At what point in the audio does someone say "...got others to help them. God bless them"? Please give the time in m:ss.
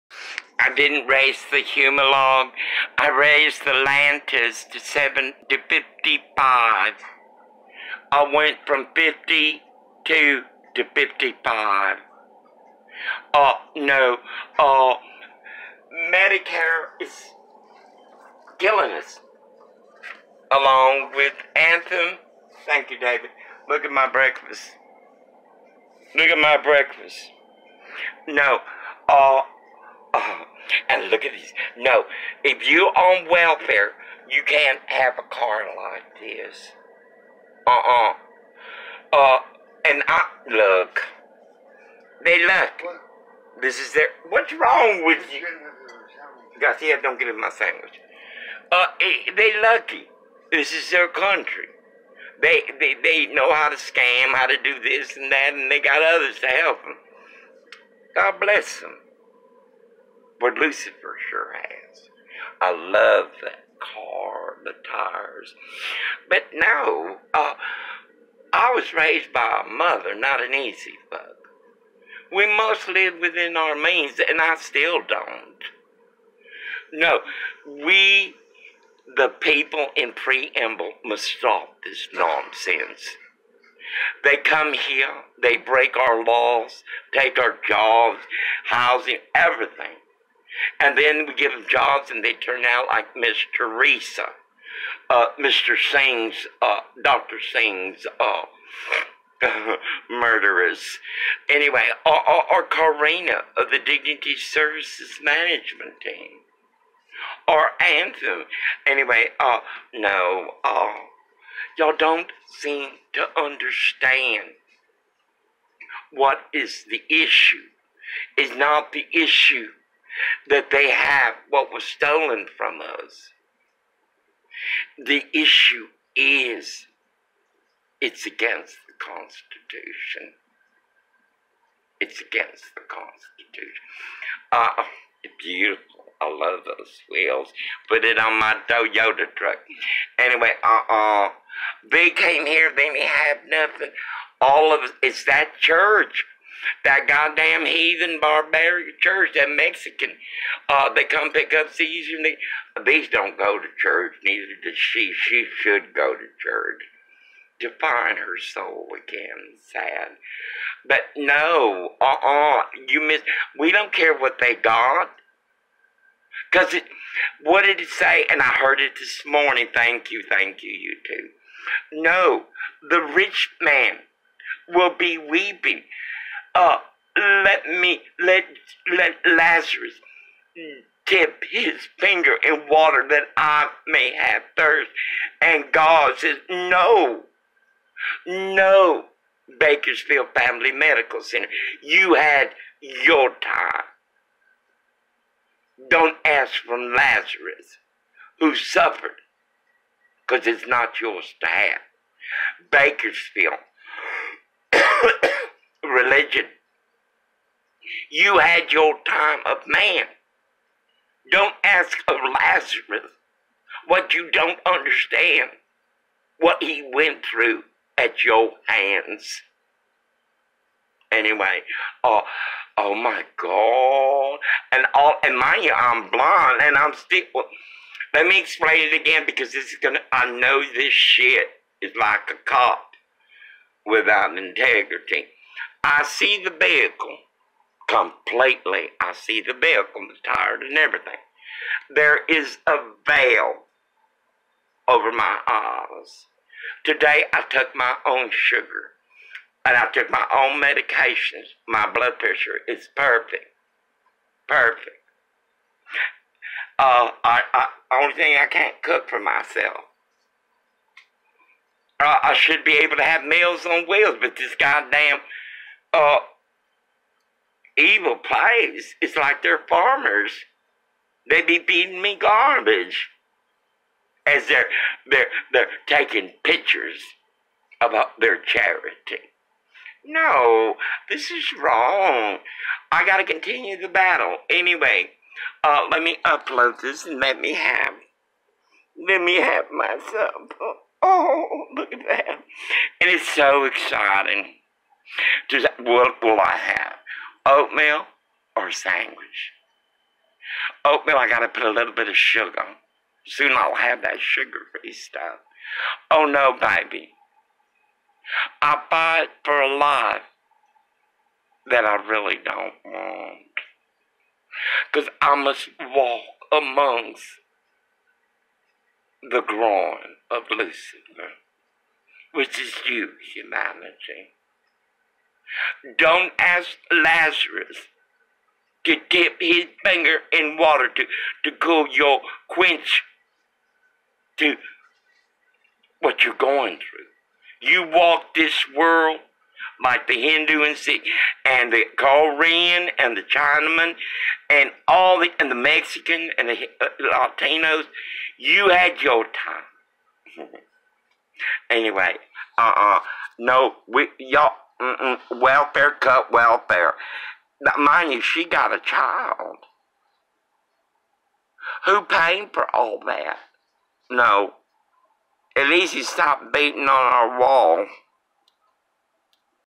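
0:55.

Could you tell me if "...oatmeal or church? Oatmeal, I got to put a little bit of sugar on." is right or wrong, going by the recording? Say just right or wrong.
wrong.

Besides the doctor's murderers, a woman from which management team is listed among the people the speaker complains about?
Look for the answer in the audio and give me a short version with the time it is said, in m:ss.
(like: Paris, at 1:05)
Dignity Services Management Team, at 1:43.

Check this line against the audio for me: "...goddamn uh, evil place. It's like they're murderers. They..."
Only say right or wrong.
wrong.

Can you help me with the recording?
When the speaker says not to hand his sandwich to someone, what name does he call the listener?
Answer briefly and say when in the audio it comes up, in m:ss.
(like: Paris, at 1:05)
Garcia, at 0:46.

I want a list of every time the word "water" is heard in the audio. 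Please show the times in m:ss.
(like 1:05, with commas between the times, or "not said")
3:02, 5:30.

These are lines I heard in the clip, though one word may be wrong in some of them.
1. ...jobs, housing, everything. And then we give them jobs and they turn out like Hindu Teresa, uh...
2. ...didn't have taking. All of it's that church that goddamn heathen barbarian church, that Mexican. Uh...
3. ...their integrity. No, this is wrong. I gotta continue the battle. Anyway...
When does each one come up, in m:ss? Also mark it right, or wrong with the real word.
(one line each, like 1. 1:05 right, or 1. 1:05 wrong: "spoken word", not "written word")
1. 1:27 wrong: "Miss", not "Hindu"
2. 2:22 wrong: "nothing", not "taking"
3. 4:38 wrong: "charity", not "integrity".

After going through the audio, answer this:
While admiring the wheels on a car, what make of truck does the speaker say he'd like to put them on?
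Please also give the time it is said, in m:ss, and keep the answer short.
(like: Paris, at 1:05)
Toyota, at 2:18.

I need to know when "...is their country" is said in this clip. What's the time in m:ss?
0:50.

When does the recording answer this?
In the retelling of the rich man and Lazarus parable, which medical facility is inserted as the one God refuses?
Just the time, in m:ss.
3:09.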